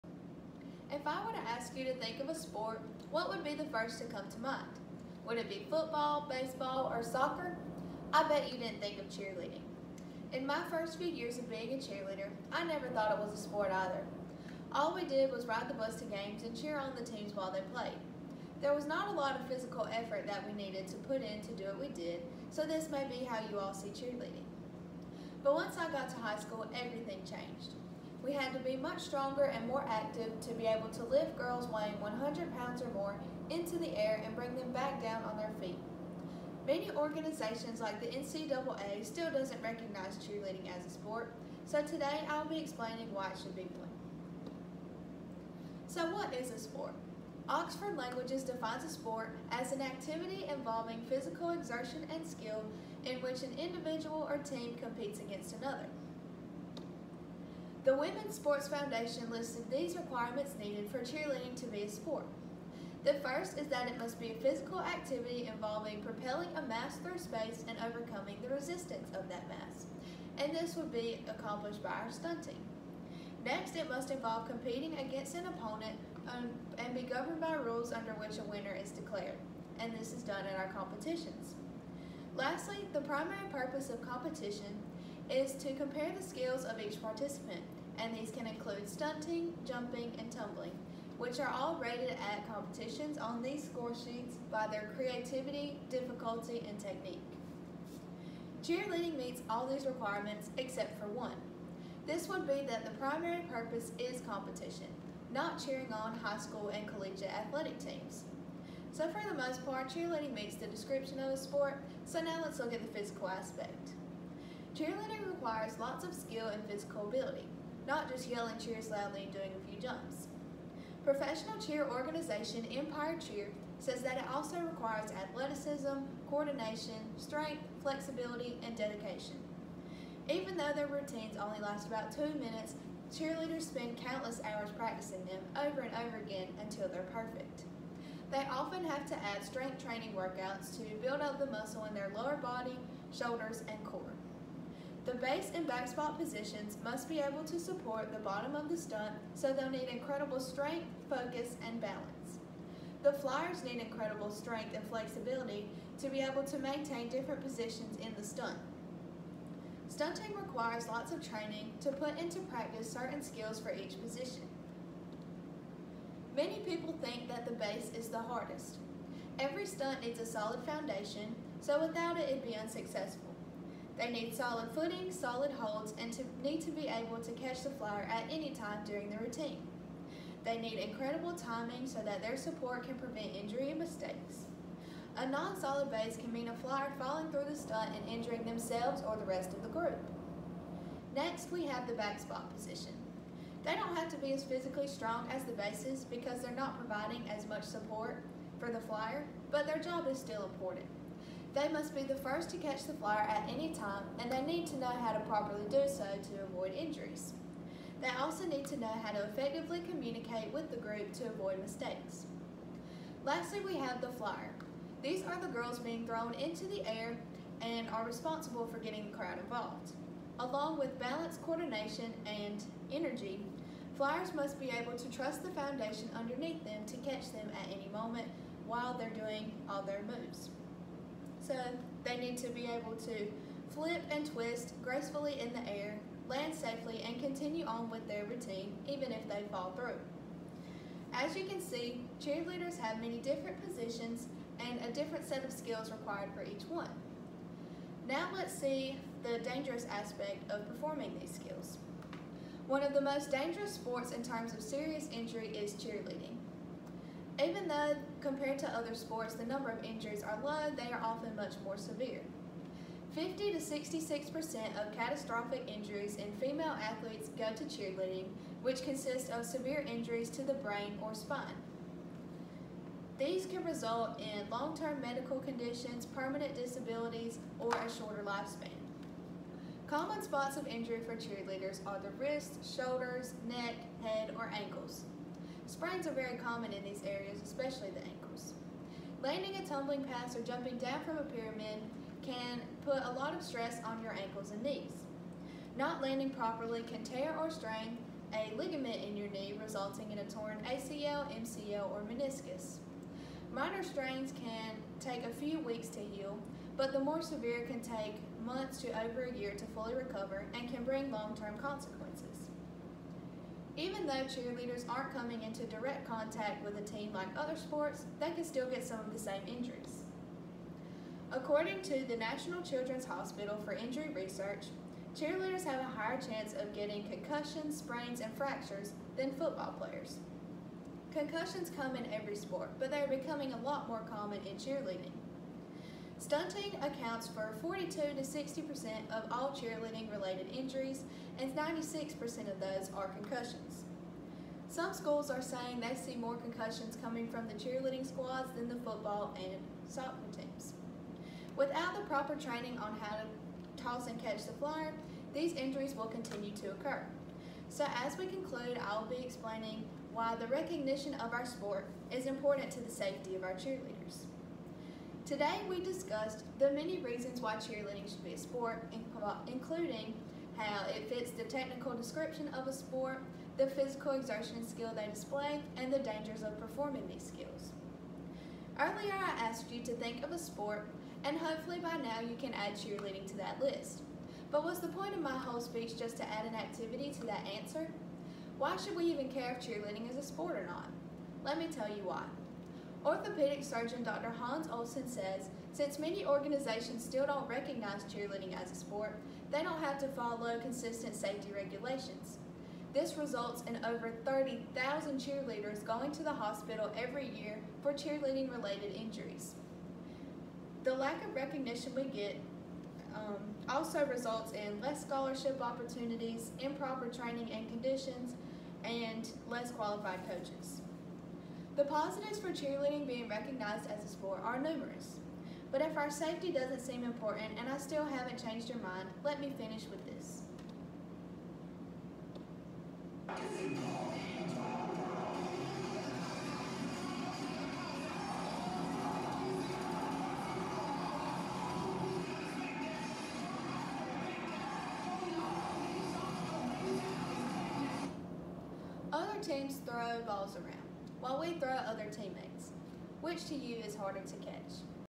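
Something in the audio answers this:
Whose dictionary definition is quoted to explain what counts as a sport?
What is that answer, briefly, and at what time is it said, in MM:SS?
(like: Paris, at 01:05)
Oxford Languages, at 00:47.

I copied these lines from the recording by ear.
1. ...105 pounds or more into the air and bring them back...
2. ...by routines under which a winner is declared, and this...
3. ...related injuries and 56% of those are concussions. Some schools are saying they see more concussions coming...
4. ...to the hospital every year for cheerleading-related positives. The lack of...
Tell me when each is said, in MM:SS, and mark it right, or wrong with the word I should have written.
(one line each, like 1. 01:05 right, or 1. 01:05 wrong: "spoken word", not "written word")
1. 00:31 wrong: "100", not "105"
2. 01:17 wrong: "rules", not "routines"
3. 05:40 wrong: "96", not "56"
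4. 06:46 wrong: "injuries", not "positives".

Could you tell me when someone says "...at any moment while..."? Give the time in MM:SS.
03:47.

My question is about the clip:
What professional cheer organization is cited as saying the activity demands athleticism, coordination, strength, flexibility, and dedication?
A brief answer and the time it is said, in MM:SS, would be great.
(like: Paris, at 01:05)
Empire Cheer, at 02:02.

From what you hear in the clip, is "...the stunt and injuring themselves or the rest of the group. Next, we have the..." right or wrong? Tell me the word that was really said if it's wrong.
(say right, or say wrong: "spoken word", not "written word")
right.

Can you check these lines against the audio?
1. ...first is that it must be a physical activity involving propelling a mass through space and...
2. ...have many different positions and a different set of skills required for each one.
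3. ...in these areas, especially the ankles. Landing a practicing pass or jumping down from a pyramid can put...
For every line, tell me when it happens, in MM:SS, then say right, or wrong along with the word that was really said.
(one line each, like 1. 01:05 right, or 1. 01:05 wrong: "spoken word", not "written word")
1. 01:03 right
2. 04:02 right
3. 04:46 wrong: "tumbling", not "practicing".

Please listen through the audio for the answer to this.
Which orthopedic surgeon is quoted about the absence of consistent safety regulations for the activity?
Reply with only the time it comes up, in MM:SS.
06:34.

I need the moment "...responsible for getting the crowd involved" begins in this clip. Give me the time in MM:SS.
03:38.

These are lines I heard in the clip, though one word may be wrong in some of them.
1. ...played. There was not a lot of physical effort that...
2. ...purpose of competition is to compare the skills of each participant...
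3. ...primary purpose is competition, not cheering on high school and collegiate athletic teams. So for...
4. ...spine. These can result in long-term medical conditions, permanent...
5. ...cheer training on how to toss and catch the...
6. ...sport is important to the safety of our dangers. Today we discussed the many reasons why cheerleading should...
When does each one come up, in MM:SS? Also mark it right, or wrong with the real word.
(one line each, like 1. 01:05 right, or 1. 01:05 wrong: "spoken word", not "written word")
1. 00:17 right
2. 01:23 right
3. 01:42 right
4. 04:31 right
5. 05:52 wrong: "proper", not "cheer"
6. 06:01 wrong: "cheerleaders", not "dangers".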